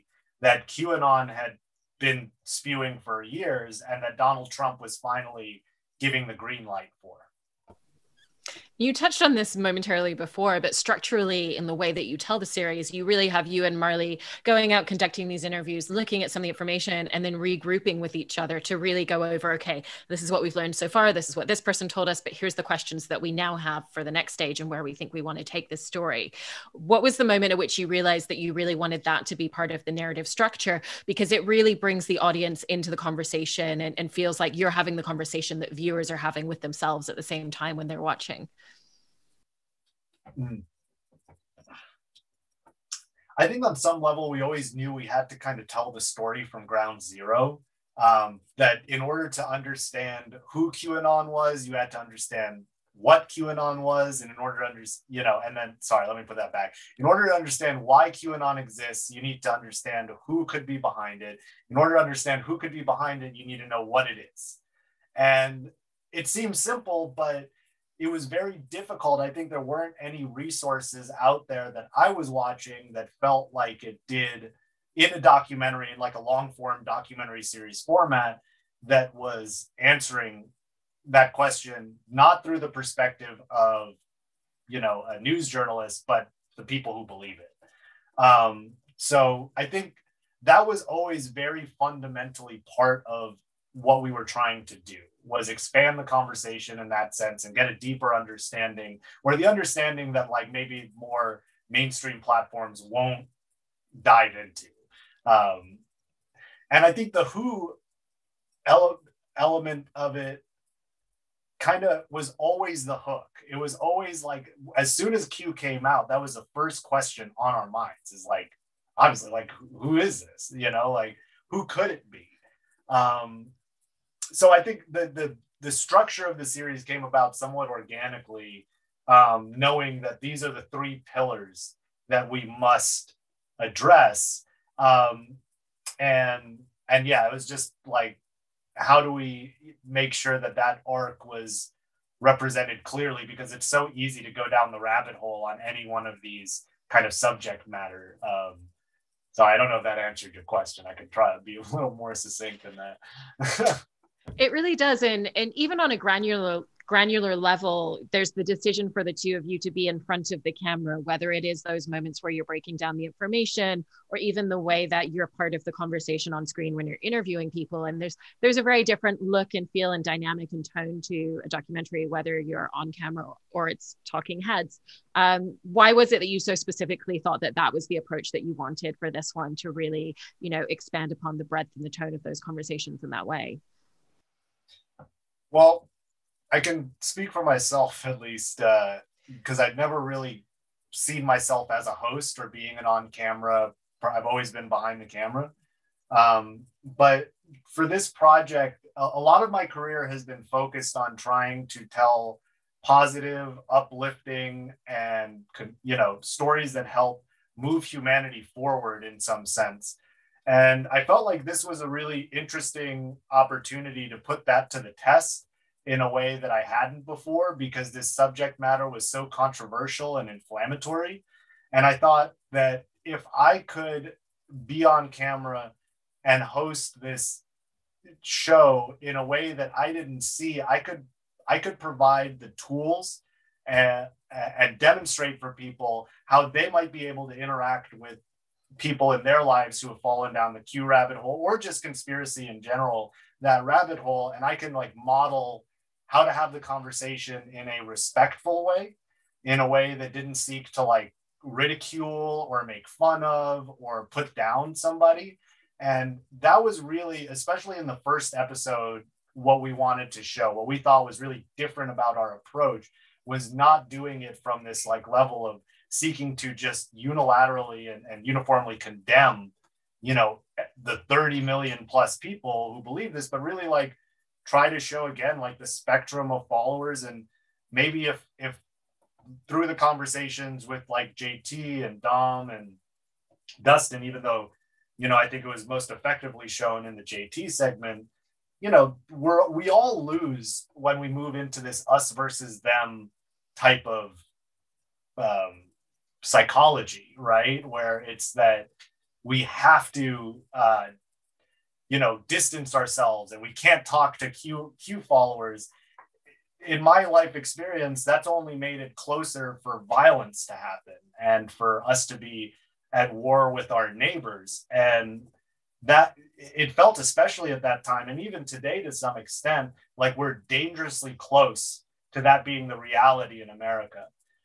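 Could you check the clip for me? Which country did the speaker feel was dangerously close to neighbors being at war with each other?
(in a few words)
America.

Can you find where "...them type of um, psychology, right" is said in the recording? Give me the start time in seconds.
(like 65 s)
292 s.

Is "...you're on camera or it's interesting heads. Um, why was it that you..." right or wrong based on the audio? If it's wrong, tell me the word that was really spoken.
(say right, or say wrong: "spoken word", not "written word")
wrong: "talking", not "interesting".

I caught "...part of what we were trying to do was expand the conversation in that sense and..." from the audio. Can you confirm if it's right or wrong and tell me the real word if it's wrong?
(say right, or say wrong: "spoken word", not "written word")
right.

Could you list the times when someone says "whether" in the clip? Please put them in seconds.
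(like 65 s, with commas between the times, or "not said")
160 s, 172 s.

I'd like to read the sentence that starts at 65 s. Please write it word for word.
And it seems simple, but it was very difficult.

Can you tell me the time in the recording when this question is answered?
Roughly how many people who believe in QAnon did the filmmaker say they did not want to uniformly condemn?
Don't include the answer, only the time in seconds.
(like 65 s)
271 s.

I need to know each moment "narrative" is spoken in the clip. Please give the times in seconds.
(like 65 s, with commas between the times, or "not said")
29 s.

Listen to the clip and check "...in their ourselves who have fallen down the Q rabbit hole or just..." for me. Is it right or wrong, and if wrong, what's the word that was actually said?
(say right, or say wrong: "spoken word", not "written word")
wrong: "lives", not "ourselves".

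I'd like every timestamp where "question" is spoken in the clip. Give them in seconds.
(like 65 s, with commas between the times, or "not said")
22 s, 81 s, 116 s, 150 s.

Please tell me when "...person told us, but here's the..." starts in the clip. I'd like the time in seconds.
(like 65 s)
21 s.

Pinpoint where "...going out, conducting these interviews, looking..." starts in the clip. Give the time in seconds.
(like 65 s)
14 s.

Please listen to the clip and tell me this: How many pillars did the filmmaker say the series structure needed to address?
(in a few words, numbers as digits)
3.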